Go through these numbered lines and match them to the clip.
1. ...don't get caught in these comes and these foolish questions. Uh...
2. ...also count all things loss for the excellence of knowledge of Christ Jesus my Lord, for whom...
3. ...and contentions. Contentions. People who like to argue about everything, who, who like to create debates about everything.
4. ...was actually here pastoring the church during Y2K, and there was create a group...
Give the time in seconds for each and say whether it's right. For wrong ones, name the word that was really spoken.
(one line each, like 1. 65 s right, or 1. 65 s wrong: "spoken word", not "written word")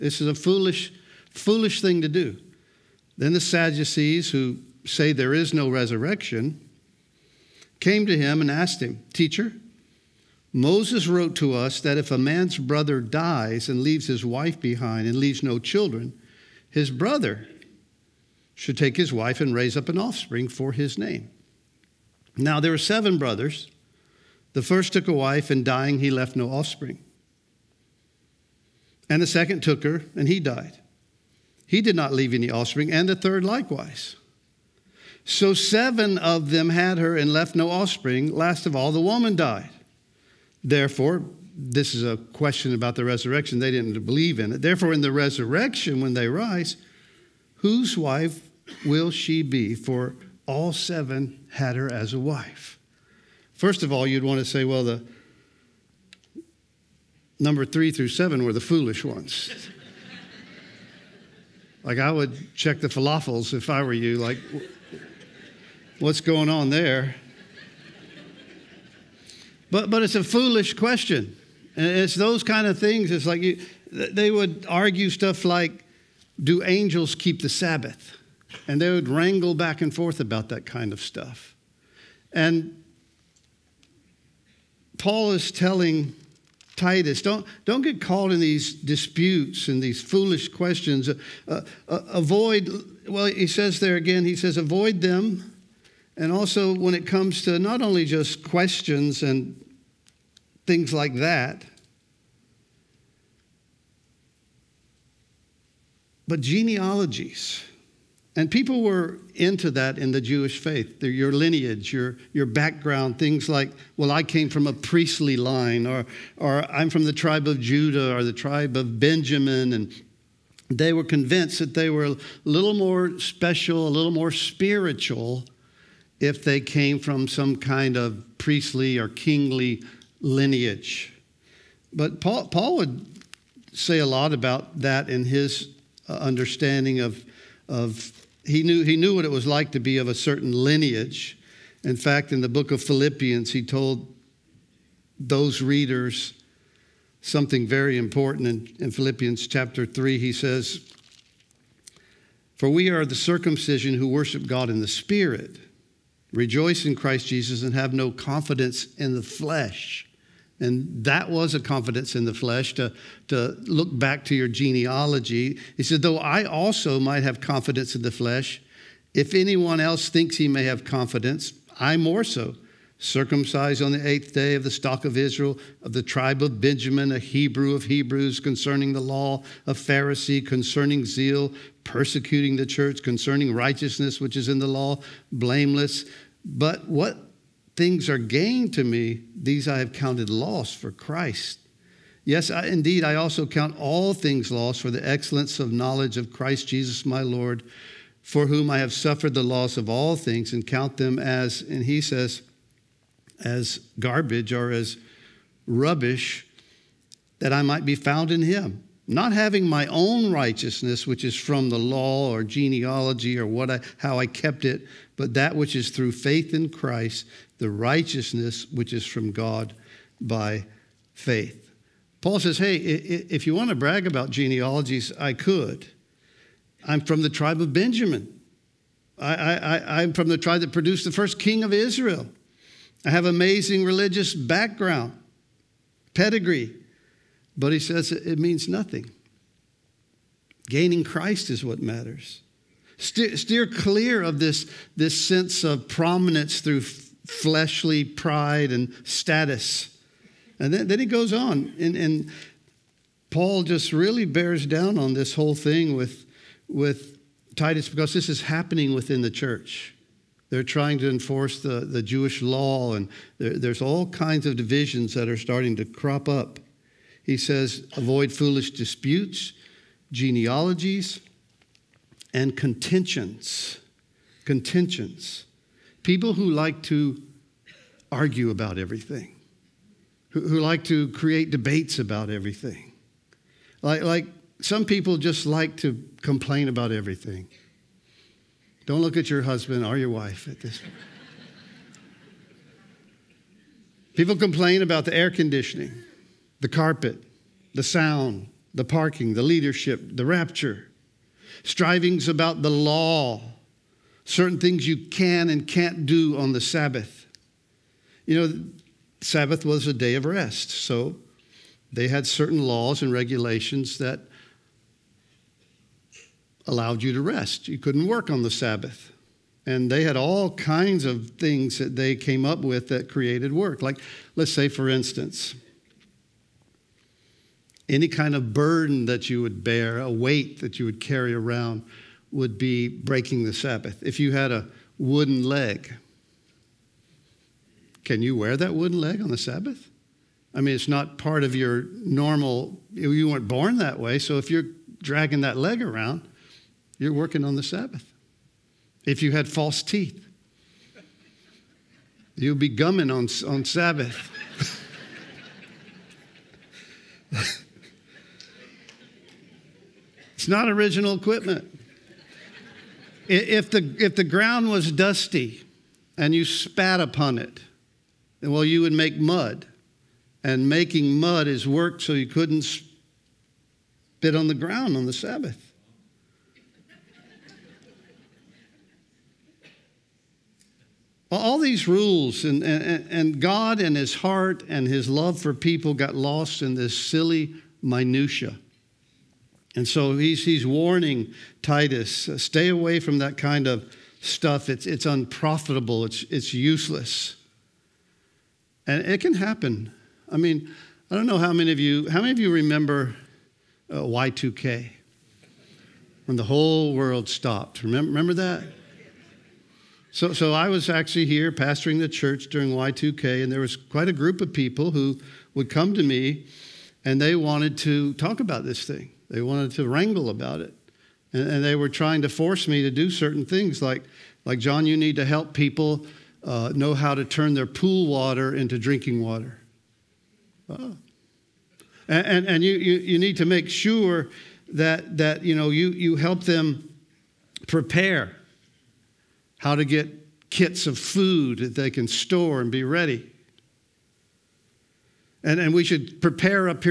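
1. 87 s wrong: "disputes", not "comes"
2. 193 s right
3. 272 s right
4. 410 s wrong: "quite", not "create".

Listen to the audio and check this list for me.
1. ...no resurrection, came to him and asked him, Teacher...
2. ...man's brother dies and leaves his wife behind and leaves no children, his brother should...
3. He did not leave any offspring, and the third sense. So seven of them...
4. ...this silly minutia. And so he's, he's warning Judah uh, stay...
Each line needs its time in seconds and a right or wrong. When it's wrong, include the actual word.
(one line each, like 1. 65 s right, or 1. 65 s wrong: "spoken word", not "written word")
1. 5 s right
2. 12 s right
3. 31 s wrong: "likewise", not "sense"
4. 386 s wrong: "Titus", not "Judah".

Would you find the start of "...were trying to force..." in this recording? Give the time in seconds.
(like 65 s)
421 s.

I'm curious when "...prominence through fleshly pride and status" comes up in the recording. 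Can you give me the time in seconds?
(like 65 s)
245 s.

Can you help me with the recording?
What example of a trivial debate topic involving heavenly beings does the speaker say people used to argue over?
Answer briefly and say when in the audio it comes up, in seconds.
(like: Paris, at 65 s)
do angels keep the Sabbath, at 76 s.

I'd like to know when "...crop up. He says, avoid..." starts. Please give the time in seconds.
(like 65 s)
265 s.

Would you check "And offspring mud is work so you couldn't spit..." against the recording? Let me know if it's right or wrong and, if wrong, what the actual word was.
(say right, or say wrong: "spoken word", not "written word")
wrong: "making", not "offspring".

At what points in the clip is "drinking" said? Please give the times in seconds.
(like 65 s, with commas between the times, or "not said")
428 s.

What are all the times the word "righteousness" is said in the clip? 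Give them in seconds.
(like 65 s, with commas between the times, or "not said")
183 s, 210 s, 217 s.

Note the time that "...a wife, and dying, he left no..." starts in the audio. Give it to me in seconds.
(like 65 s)
25 s.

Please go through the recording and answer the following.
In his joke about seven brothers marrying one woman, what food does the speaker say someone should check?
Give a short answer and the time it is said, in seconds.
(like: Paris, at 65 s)
falafels, at 62 s.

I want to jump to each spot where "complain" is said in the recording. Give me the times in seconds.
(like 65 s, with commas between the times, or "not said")
286 s, 294 s.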